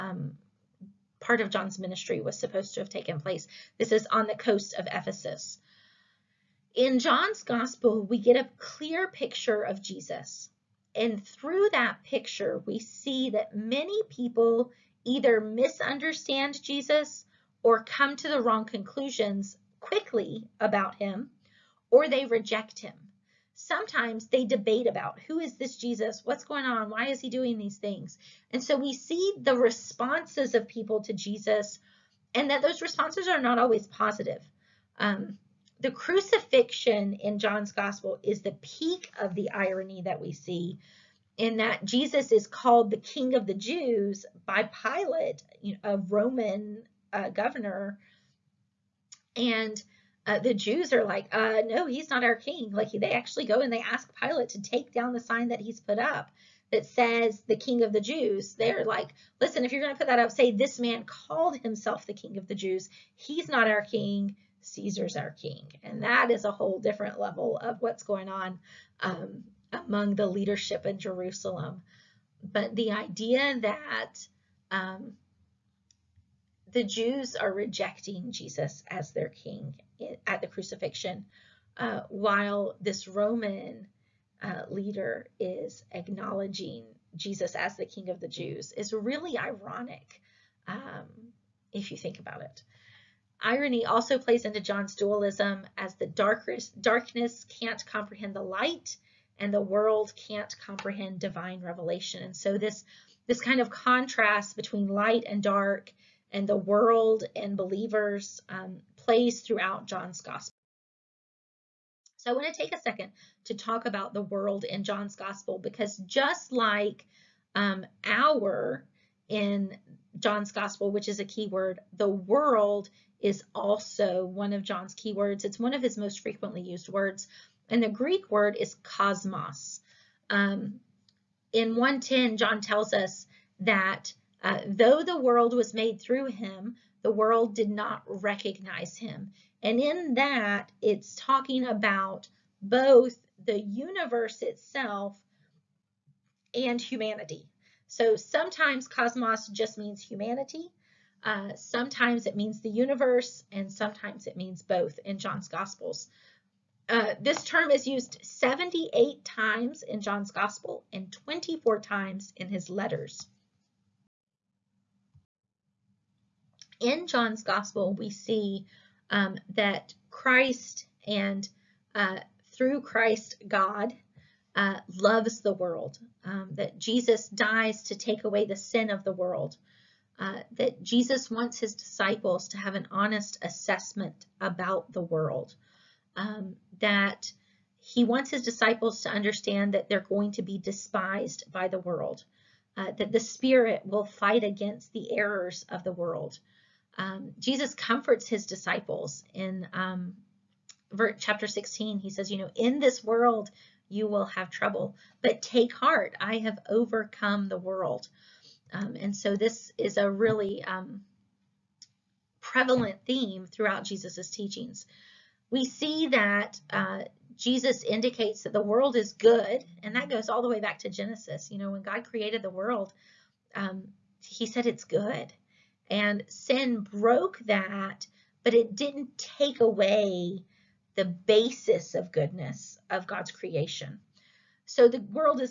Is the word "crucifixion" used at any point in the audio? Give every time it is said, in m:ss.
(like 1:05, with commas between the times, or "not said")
0:35, 1:20.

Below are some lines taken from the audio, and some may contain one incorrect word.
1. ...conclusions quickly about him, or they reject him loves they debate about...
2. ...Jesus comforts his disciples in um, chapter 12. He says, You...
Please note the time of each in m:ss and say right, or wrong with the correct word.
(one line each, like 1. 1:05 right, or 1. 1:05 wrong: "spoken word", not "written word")
1. 0:18 wrong: "sometimes", not "loves"
2. 3:17 wrong: "16", not "12".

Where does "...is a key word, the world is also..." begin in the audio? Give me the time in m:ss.
2:01.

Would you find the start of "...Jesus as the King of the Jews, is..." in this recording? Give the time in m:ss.
1:27.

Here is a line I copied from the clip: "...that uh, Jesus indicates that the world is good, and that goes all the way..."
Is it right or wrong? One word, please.
right.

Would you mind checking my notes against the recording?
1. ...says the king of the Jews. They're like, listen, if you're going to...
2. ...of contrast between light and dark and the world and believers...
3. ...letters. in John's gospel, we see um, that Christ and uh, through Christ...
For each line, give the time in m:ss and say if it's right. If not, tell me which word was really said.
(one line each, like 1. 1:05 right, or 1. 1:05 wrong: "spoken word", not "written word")
1. 0:56 right
2. 1:43 right
3. 2:42 right.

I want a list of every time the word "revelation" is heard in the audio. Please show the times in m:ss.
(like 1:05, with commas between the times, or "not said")
1:41.